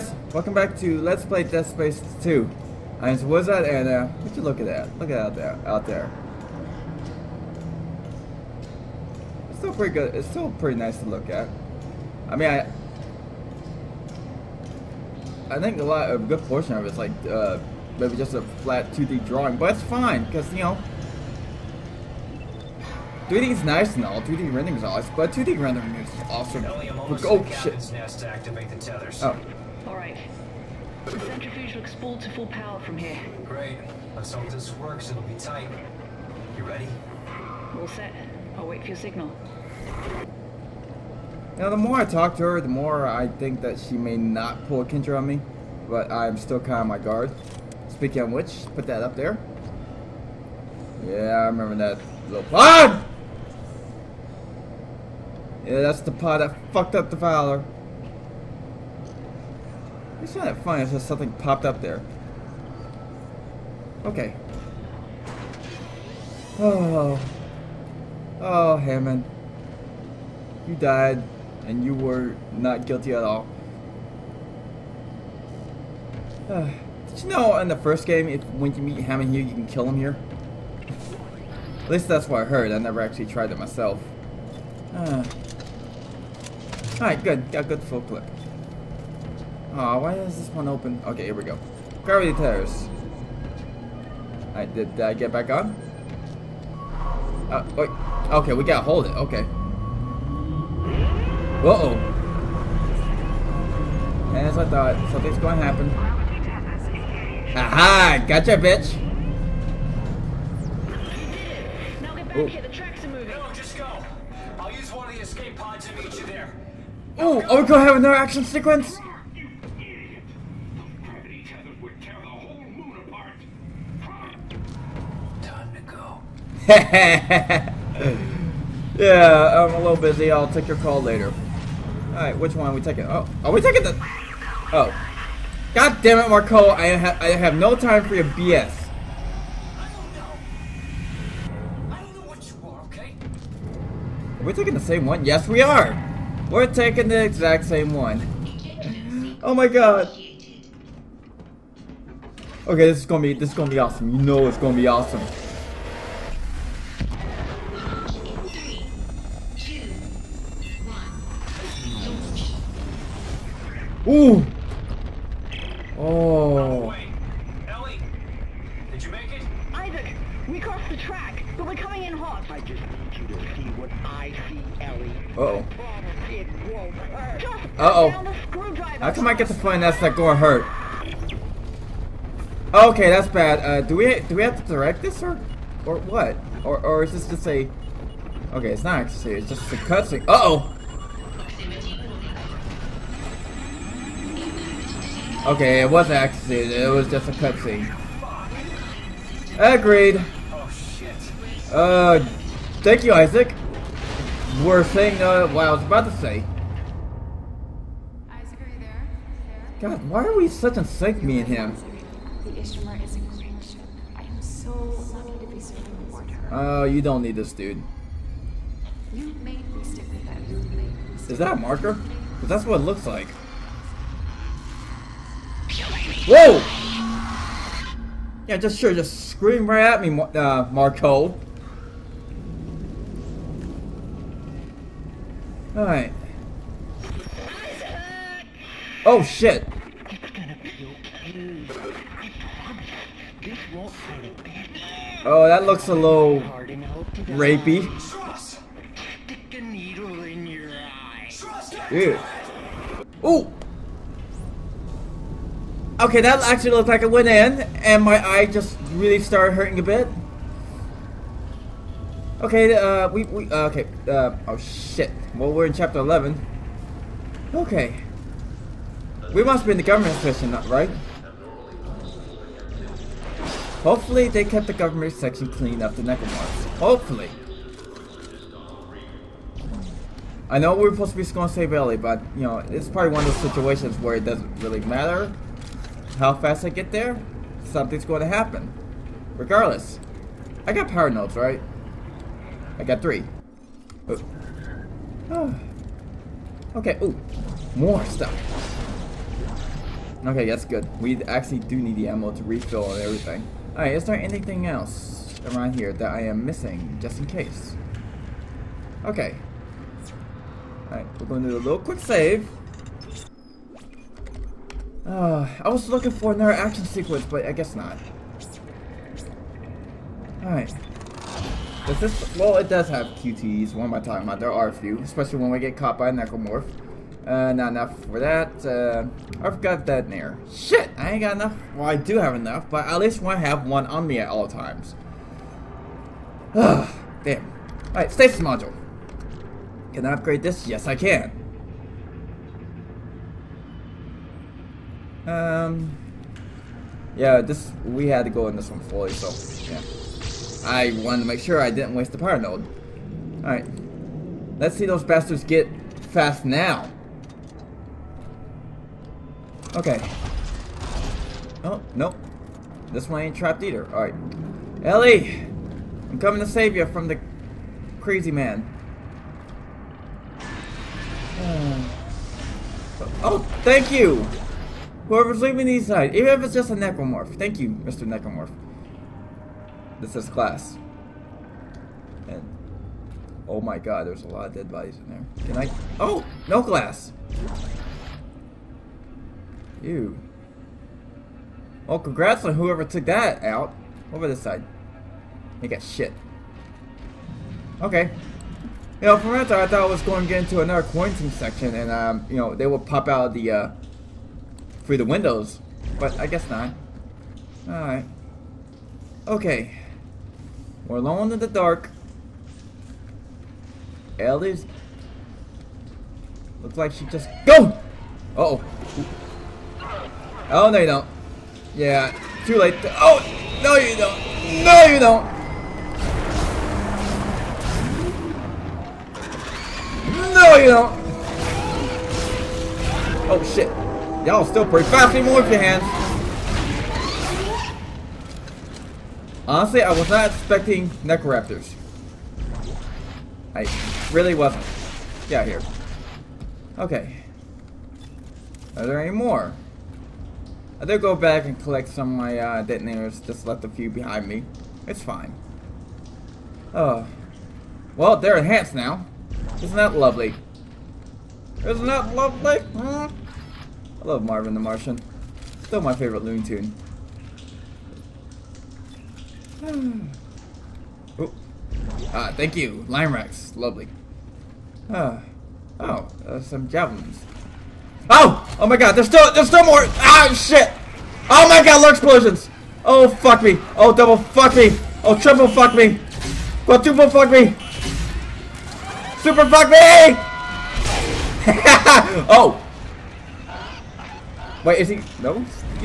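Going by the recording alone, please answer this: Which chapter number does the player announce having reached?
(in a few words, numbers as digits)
11.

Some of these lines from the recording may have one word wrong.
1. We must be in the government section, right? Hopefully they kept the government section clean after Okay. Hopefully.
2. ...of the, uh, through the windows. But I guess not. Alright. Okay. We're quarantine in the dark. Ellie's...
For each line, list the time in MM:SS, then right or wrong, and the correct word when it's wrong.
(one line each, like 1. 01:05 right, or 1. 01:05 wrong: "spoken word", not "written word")
1. 04:29 wrong: "Necromorphs", not "Okay"
2. 06:43 wrong: "alone", not "quarantine".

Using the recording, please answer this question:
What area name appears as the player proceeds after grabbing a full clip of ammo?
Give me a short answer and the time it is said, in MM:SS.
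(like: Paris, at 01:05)
Gravity Terrace, at 01:32.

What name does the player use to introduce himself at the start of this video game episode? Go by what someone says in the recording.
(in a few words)
Wizard.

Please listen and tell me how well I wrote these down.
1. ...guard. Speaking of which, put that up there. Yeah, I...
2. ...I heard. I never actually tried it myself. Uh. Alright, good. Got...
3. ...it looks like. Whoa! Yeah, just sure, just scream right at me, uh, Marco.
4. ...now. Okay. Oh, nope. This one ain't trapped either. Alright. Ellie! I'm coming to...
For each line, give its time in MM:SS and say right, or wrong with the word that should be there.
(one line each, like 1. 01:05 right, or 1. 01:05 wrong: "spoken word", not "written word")
1. 00:46 right
2. 01:22 right
3. 03:42 right
4. 05:56 right.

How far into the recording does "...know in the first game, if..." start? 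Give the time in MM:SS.
01:17.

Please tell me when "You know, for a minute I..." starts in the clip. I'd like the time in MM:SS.
06:38.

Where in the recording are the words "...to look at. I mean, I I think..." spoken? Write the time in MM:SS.
00:10.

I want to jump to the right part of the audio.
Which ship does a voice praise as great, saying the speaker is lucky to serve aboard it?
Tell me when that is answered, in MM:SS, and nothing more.
03:32.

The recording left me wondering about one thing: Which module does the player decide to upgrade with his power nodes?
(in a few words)
Stasis module.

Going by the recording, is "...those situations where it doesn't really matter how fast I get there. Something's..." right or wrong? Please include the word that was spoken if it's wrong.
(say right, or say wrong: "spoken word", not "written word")
right.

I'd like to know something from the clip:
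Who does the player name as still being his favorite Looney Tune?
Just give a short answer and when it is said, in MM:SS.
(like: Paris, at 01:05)
Marvin the Martian, at 07:44.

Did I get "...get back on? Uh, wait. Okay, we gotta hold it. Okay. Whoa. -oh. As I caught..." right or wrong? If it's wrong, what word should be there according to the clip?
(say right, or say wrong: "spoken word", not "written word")
wrong: "thought", not "caught".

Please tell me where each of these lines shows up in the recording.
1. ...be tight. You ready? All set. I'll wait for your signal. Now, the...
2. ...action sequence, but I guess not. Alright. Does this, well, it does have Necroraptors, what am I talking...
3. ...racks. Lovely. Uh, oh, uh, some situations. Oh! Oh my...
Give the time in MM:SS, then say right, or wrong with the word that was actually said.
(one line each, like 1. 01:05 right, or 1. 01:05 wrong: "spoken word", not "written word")
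1. 00:35 right
2. 05:16 wrong: "QTEs", not "Necroraptors"
3. 07:53 wrong: "javelins", not "situations".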